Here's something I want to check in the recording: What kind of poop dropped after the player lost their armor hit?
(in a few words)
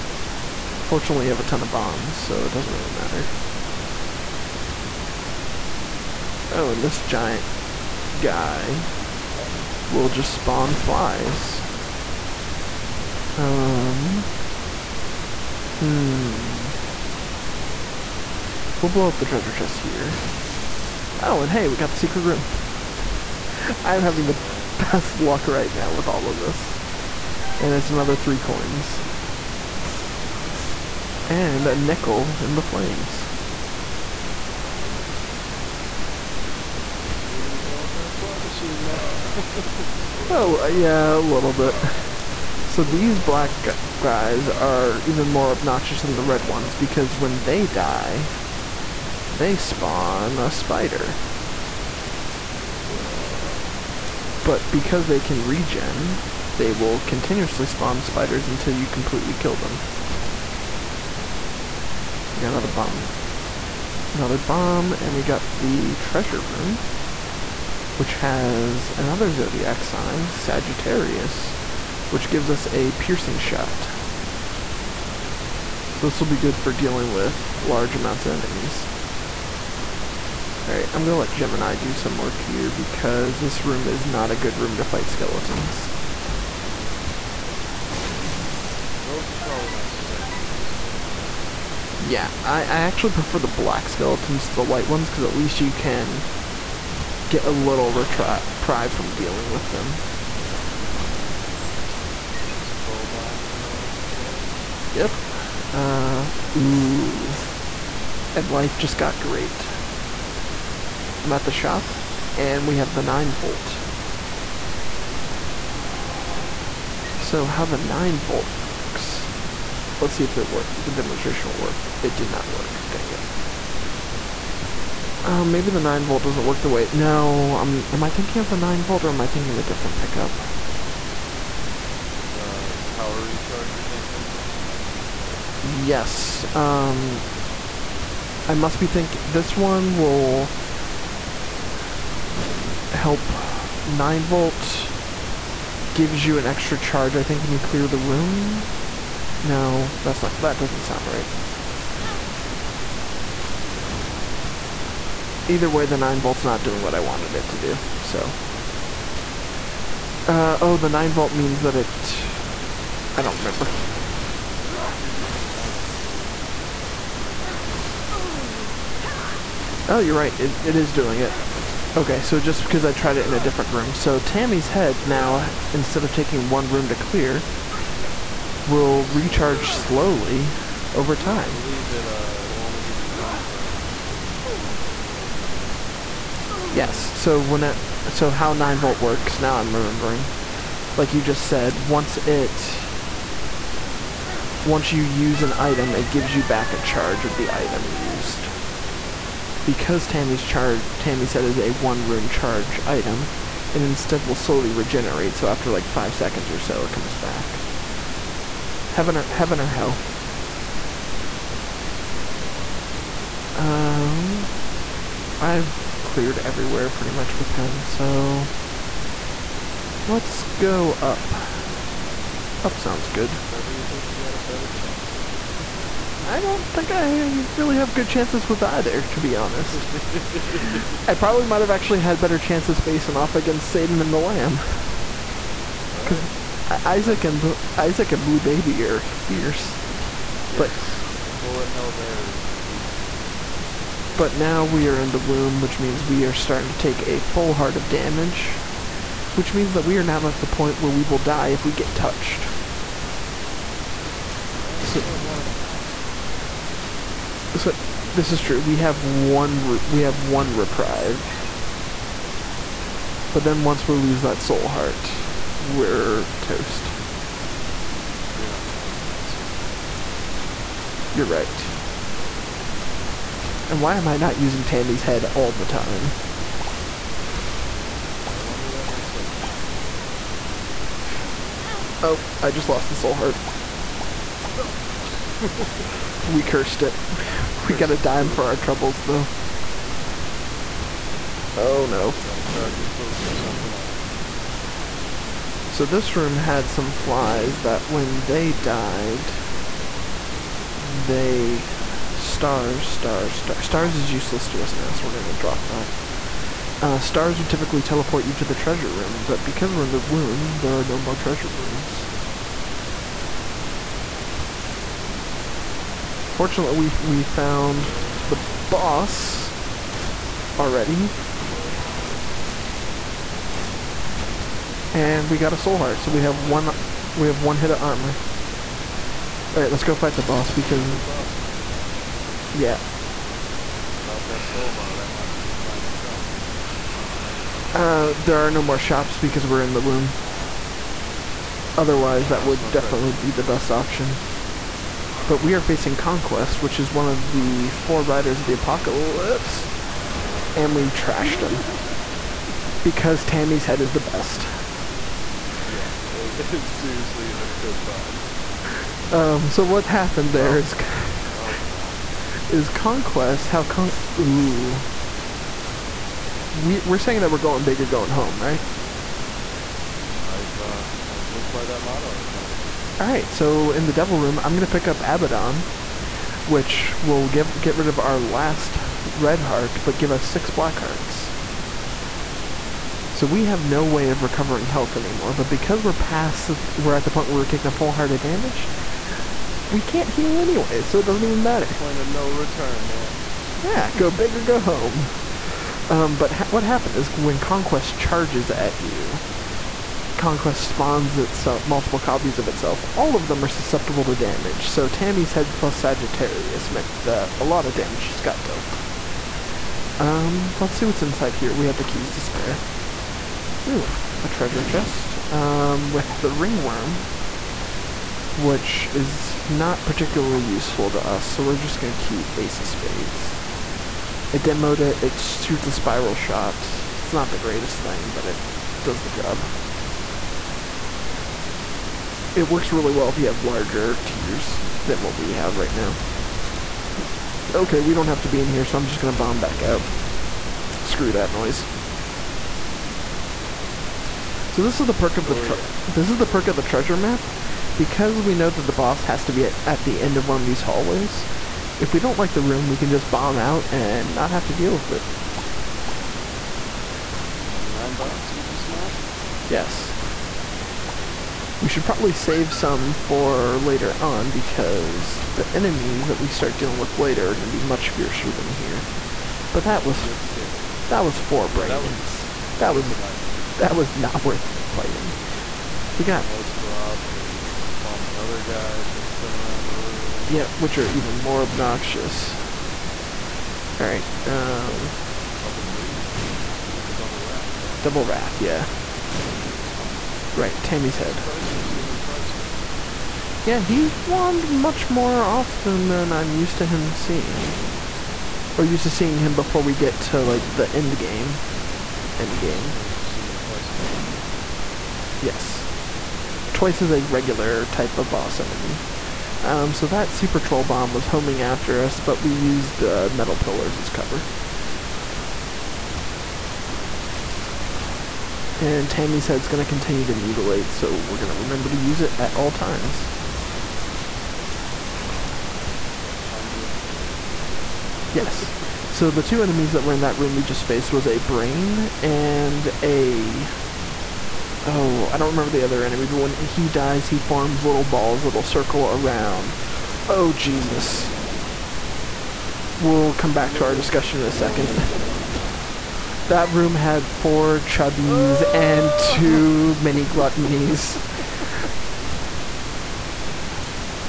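Dime poop.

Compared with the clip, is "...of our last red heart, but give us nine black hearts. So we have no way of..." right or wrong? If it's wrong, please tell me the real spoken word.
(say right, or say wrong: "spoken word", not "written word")
wrong: "six", not "nine".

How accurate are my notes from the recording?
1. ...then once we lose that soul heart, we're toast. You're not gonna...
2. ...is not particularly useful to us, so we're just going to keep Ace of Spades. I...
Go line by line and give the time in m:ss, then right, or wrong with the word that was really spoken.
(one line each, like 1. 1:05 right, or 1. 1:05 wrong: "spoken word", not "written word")
1. 4:23 right
2. 6:58 right.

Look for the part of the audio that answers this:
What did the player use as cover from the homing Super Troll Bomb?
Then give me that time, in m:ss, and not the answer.
8:33.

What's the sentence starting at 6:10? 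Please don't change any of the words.
I've uh, I've lived by that motto at times.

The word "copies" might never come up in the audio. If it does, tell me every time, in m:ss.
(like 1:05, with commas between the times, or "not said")
6:41.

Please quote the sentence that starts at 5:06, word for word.
Uh, stars would typically teleport you to the treasure room, but because we're in the womb, there are no more treasure rooms.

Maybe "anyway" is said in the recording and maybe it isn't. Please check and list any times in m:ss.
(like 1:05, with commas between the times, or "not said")
6:30.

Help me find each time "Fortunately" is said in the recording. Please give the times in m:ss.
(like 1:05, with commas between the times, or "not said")
0:00, 5:16.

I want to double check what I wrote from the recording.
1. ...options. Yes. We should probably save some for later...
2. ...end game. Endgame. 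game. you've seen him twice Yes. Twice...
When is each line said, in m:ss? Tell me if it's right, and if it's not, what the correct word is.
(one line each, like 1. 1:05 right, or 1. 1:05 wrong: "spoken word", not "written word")
1. 7:38 right
2. 8:20 right.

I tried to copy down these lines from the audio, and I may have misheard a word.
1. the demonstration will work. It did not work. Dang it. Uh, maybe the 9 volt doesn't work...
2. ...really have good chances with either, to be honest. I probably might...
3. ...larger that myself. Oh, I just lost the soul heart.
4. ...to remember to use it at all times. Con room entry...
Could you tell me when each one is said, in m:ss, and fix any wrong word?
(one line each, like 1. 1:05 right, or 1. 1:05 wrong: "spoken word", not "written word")
1. 2:00 right
2. 3:47 right
3. 4:38 wrong: "wonder", not "larger"
4. 8:41 right.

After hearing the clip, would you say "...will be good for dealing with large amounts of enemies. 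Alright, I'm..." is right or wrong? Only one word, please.
right.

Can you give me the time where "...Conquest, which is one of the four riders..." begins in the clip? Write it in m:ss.
5:45.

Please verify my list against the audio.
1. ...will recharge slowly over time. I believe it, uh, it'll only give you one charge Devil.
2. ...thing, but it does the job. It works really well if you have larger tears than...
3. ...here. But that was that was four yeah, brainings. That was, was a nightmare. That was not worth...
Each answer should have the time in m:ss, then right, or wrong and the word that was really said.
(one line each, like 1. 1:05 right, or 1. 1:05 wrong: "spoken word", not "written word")
1. 2:58 wrong: "Yes", not "Devil"
2. 7:07 right
3. 7:48 right.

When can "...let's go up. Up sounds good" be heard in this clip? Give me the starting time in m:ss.
3:40.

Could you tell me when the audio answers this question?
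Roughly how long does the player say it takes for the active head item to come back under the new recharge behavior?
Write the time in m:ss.
3:25.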